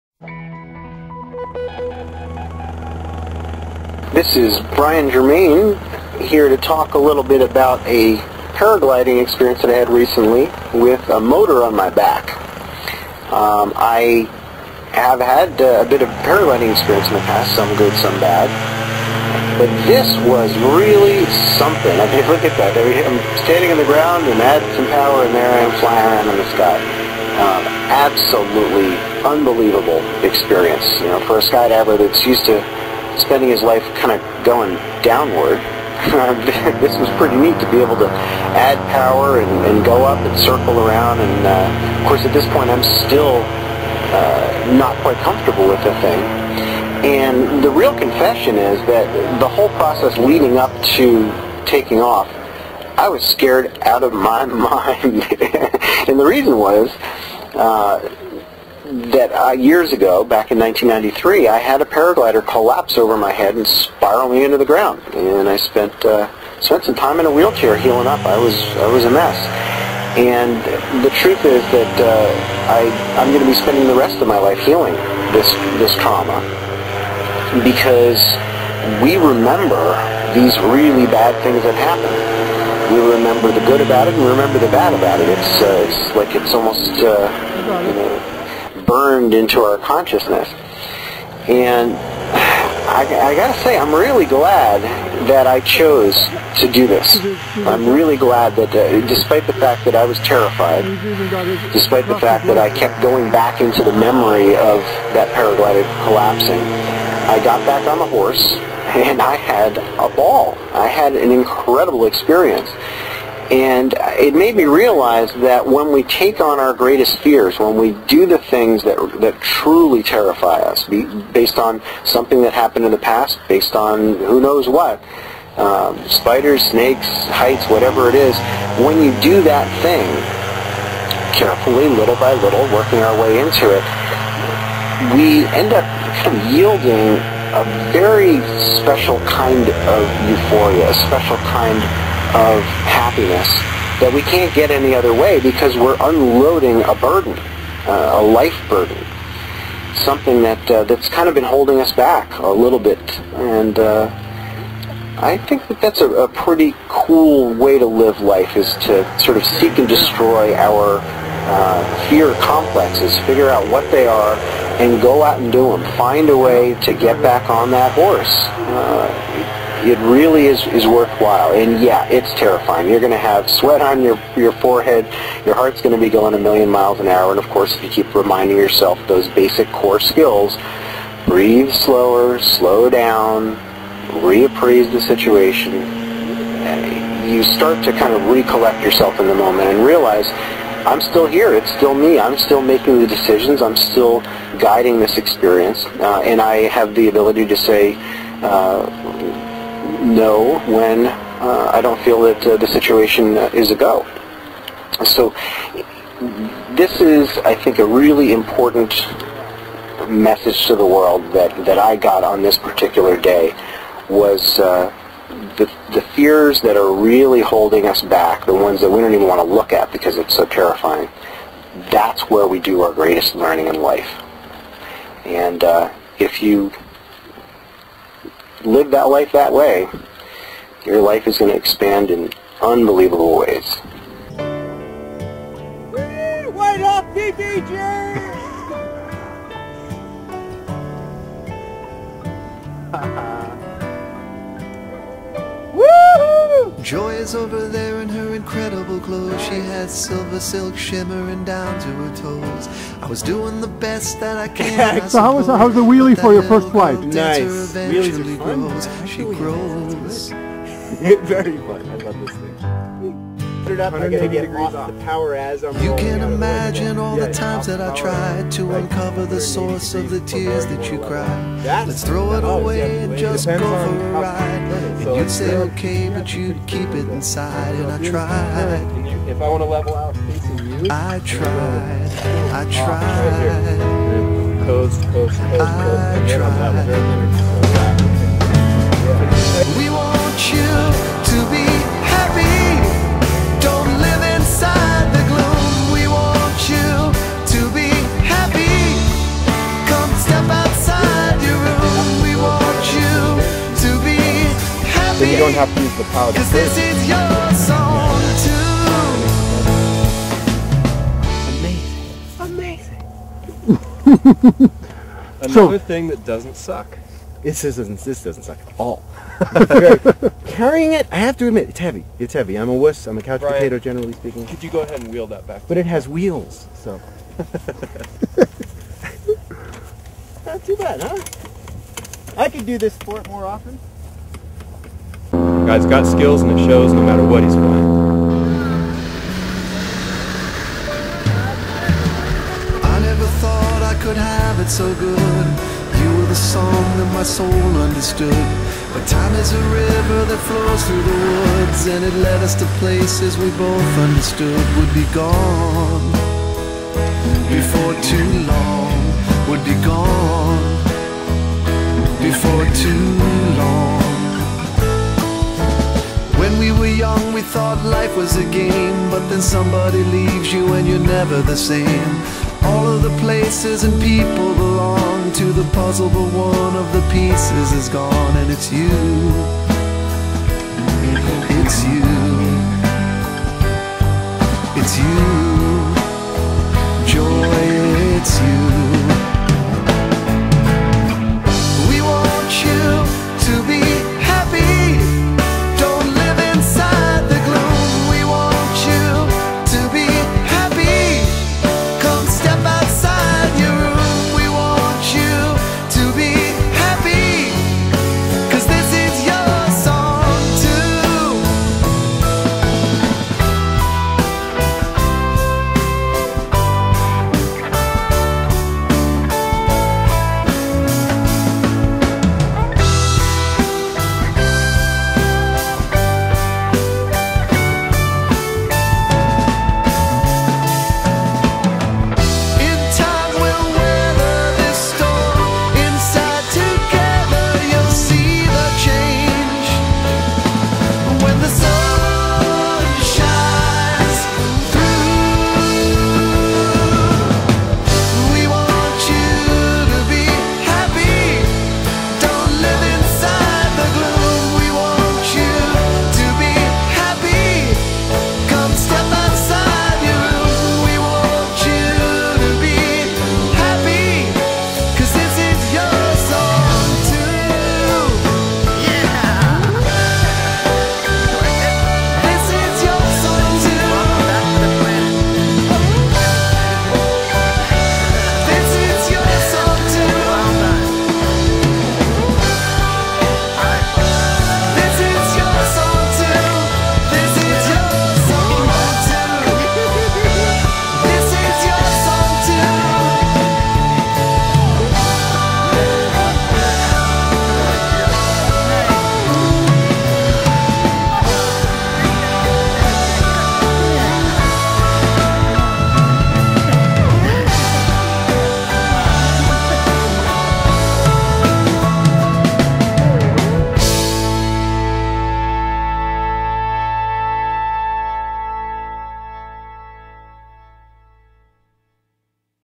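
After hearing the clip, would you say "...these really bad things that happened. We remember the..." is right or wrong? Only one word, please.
right.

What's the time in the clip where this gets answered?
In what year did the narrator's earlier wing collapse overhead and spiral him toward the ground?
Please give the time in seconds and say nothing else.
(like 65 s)
60 s.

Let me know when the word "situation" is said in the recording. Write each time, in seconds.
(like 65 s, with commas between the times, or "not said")
185 s, 202 s.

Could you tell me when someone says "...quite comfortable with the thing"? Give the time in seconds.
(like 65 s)
45 s.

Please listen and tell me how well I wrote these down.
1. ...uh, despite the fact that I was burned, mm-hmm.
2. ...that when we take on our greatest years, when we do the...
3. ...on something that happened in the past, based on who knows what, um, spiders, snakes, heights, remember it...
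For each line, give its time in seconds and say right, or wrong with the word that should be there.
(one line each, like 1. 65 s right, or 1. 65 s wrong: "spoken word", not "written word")
1. 98 s wrong: "terrified", not "burned"
2. 115 s wrong: "fears", not "years"
3. 121 s wrong: "whatever", not "remember".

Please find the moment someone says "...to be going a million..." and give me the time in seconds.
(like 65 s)
175 s.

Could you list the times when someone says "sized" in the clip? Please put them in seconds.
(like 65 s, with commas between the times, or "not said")
not said.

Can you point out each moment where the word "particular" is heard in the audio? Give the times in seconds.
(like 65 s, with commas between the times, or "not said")
212 s.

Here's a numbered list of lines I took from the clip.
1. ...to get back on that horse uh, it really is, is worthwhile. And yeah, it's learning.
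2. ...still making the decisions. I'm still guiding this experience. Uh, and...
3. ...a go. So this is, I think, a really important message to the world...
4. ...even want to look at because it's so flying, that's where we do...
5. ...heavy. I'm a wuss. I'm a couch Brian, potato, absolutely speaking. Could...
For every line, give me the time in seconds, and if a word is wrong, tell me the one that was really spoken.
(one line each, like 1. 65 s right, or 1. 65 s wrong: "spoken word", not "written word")
1. 166 s wrong: "terrifying", not "learning"
2. 192 s right
3. 203 s right
4. 219 s wrong: "terrifying", not "flying"
5. 322 s wrong: "generally", not "absolutely".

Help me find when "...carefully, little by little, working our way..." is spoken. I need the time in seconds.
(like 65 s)
131 s.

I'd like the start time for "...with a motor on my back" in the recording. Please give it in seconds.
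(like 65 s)
10 s.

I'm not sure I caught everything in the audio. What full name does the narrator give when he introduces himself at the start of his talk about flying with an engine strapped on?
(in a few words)
Brian Germain.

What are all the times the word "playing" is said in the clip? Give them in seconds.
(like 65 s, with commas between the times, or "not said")
337 s.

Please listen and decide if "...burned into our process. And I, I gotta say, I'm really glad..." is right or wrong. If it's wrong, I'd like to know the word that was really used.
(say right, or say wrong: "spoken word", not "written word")
wrong: "consciousness", not "process".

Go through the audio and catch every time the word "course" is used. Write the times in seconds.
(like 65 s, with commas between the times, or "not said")
42 s, 177 s.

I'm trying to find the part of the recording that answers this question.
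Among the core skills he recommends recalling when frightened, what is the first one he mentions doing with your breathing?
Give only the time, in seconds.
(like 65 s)
181 s.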